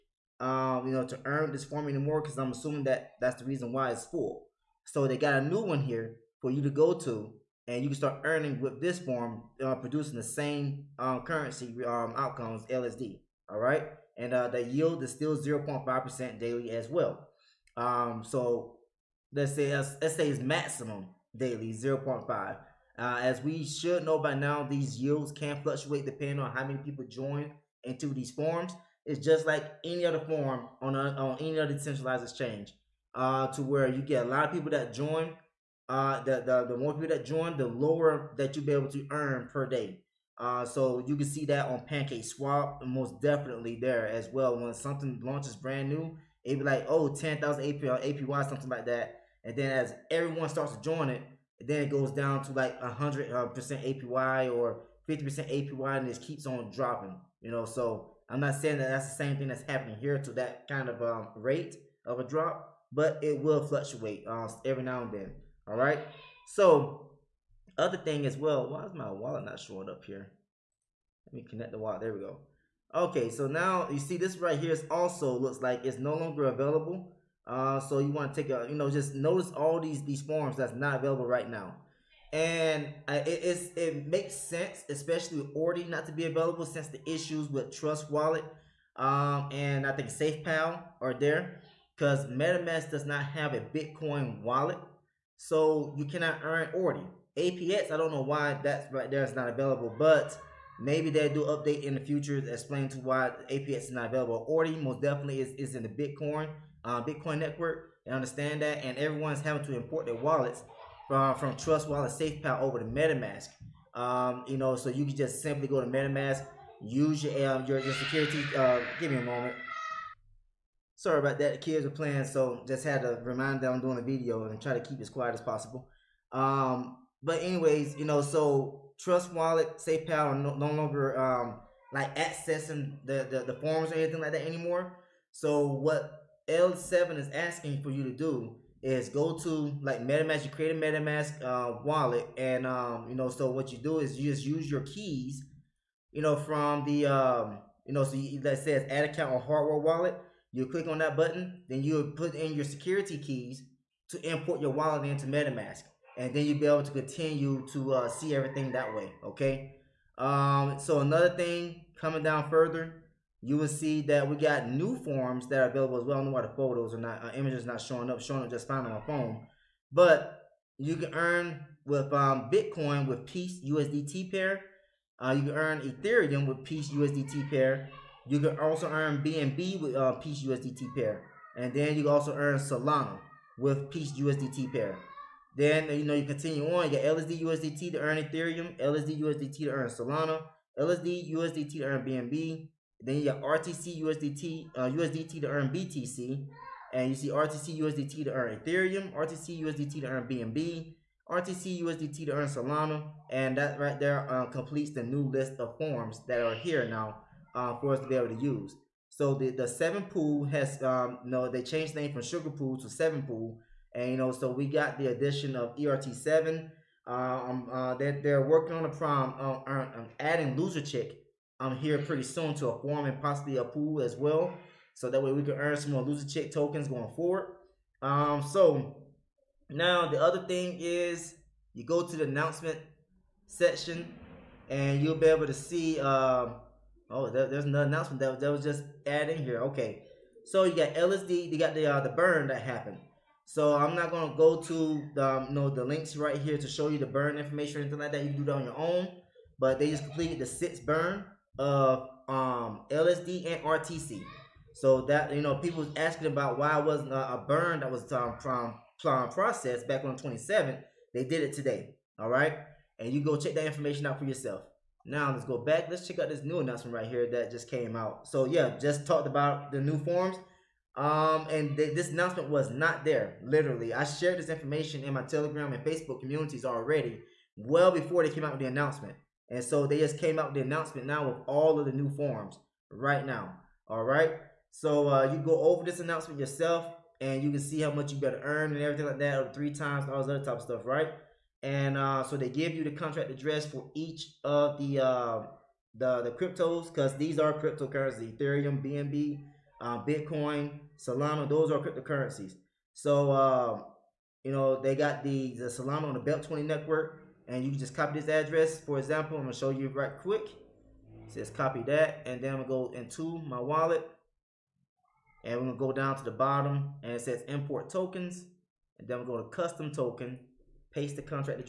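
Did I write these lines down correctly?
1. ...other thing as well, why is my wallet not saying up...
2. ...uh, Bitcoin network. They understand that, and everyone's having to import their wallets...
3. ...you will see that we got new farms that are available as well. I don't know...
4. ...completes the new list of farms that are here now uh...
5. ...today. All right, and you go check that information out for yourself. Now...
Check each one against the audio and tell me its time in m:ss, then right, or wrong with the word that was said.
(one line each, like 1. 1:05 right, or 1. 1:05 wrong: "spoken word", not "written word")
1. 1:07 wrong: "showing", not "saying"
2. 1:46 right
3. 2:43 right
4. 3:24 right
5. 4:21 right.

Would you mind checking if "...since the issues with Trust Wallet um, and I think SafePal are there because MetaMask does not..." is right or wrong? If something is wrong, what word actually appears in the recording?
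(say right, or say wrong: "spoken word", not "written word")
right.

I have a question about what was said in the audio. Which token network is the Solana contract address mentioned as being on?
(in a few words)
BEP20.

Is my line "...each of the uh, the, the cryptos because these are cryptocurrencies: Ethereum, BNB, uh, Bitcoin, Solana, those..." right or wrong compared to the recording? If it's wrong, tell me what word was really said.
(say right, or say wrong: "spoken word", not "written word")
right.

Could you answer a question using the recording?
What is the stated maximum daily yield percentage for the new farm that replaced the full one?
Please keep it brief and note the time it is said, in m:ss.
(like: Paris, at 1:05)
0.5%, at 0:15.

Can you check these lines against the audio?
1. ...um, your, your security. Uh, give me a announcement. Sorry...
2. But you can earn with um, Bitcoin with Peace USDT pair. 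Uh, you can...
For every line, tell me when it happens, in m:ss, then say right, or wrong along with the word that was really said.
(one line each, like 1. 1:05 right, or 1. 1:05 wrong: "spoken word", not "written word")
1. 1:57 wrong: "moment", not "announcement"
2. 2:49 right.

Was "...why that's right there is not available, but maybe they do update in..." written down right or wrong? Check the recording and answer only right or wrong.
right.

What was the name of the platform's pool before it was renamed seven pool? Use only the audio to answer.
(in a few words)
sugar pool.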